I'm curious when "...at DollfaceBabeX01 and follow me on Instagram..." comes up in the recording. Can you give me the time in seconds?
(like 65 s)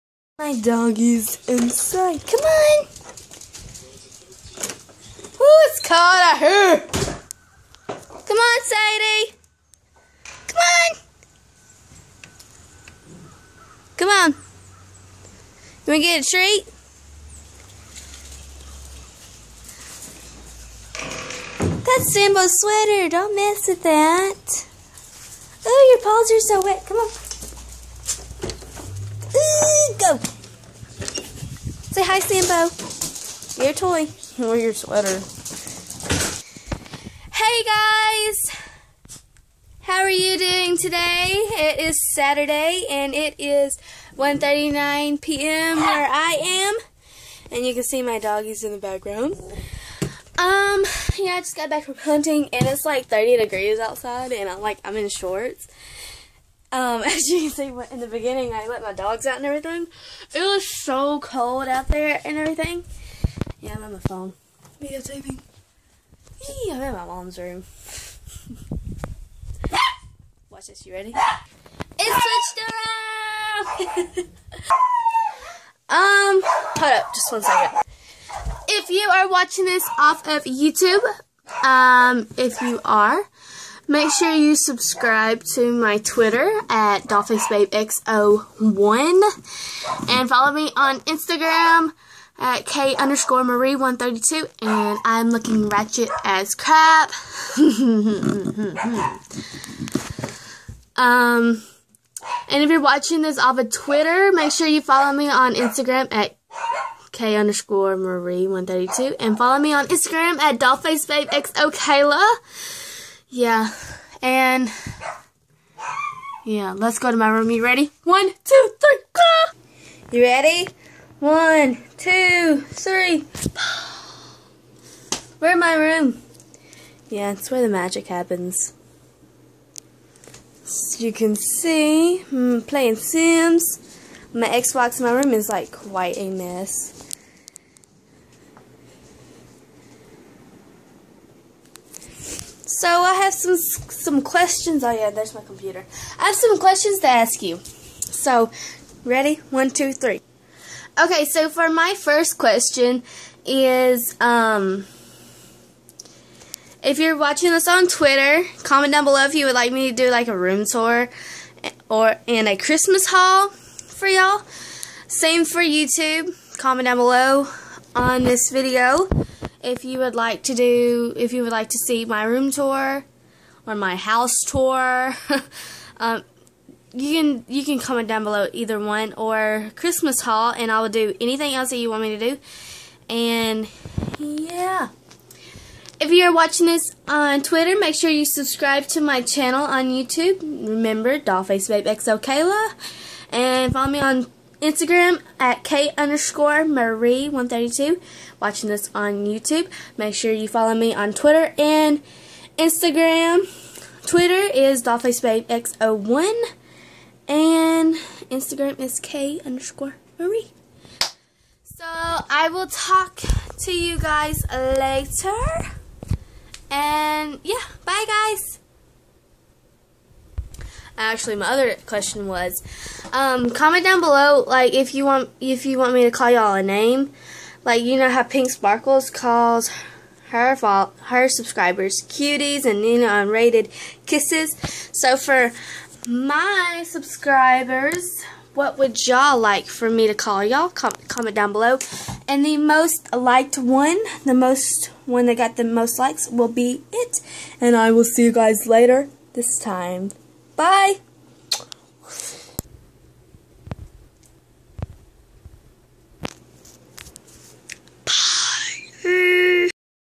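86 s.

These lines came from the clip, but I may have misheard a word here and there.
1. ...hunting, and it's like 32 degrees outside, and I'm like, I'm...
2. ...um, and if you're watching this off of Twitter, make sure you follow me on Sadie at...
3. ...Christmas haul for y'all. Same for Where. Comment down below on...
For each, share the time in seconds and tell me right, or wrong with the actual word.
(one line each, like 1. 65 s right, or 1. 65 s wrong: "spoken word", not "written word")
1. 51 s wrong: "30", not "32"
2. 100 s wrong: "Instagram", not "Sadie"
3. 162 s wrong: "YouTube", not "Where".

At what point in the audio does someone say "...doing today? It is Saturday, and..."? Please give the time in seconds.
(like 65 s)
40 s.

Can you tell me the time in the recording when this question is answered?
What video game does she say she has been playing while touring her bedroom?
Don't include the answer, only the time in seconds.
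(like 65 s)
132 s.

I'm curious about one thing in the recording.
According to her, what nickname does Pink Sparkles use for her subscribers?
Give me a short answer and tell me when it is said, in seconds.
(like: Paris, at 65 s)
cuties, at 232 s.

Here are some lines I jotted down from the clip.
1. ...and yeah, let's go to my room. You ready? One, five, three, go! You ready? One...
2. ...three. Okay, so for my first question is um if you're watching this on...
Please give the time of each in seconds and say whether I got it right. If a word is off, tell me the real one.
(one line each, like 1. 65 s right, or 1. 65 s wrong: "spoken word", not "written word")
1. 114 s wrong: "two", not "five"
2. 149 s right.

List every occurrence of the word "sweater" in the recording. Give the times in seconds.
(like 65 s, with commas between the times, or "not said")
22 s, 34 s.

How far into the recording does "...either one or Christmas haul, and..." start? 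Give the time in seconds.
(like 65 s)
178 s.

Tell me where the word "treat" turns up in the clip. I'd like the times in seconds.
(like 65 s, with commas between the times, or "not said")
16 s.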